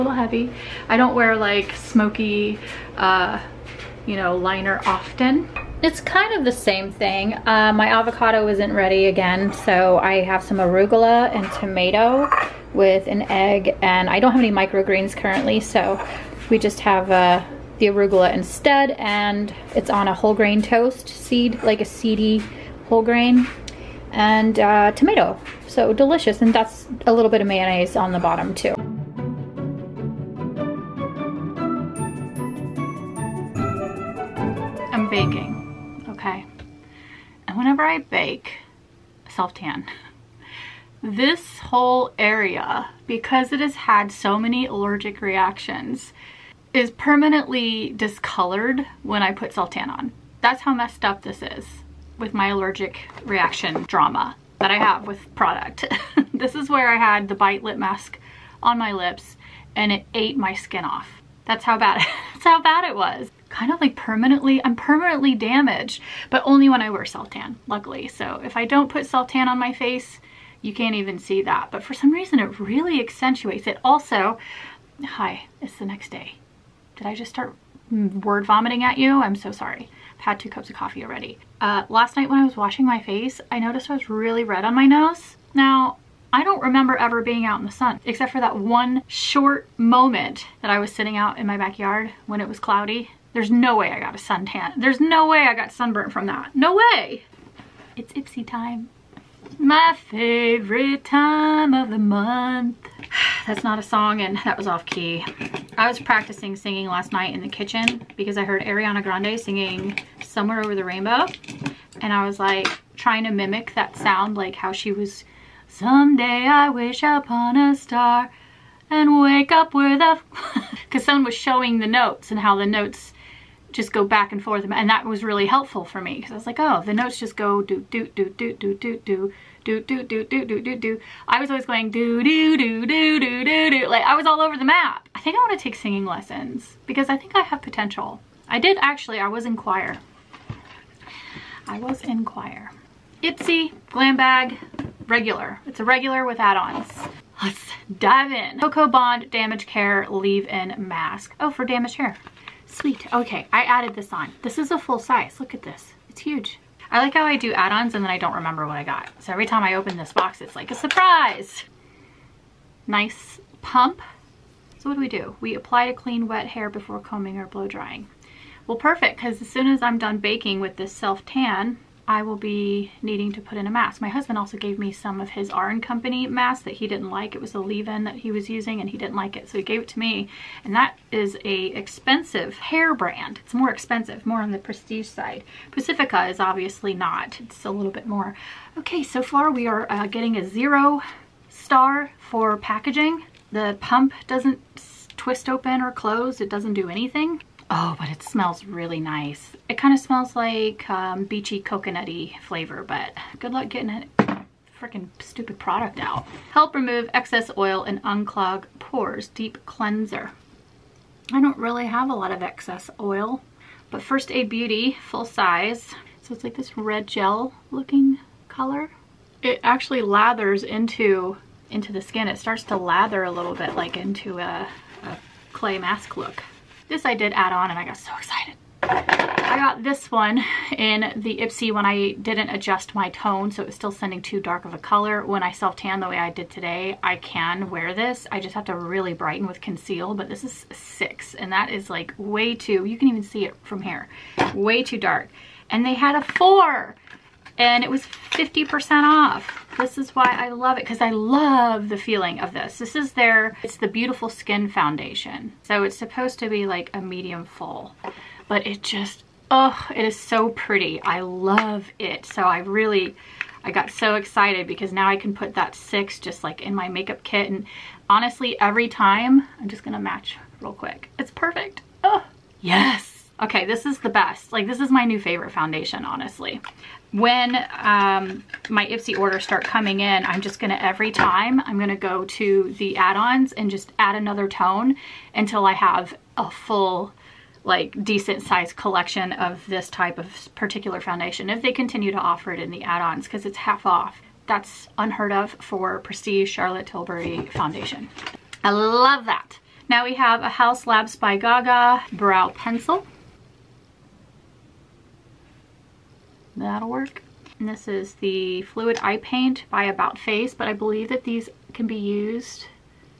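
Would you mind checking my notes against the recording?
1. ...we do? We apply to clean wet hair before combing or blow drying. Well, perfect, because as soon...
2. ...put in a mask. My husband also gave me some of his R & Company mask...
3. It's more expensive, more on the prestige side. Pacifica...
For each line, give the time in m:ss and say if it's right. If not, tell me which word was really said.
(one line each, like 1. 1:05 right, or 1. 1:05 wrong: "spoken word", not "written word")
1. 2:45 right
2. 2:53 right
3. 3:03 right.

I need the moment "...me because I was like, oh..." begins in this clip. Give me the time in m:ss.
2:06.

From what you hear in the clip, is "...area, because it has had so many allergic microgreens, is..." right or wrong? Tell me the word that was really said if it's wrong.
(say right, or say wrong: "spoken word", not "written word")
wrong: "reactions", not "microgreens".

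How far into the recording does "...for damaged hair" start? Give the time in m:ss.
2:31.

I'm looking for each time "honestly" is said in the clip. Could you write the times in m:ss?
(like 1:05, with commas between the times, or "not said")
4:28, 4:36.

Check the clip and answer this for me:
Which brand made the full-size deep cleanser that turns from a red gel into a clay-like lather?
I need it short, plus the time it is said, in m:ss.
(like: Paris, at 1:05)
First Aid Beauty, at 3:34.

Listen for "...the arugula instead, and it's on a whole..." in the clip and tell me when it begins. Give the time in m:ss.
0:17.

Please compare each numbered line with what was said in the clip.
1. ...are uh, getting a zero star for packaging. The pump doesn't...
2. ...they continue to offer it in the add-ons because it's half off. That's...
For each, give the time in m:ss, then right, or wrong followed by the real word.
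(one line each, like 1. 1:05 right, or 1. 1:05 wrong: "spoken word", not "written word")
1. 3:09 right
2. 4:51 right.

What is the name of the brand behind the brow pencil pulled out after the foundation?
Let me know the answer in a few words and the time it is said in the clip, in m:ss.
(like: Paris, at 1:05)
Haus Labs, at 5:00.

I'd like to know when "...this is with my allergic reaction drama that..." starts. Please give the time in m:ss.
0:51.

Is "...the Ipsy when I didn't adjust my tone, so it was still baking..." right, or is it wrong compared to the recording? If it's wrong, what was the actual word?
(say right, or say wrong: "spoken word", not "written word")
wrong: "sending", not "baking".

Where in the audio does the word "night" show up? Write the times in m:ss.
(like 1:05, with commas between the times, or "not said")
1:22, 1:47.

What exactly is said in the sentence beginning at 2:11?
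I was always going do do do do do do do.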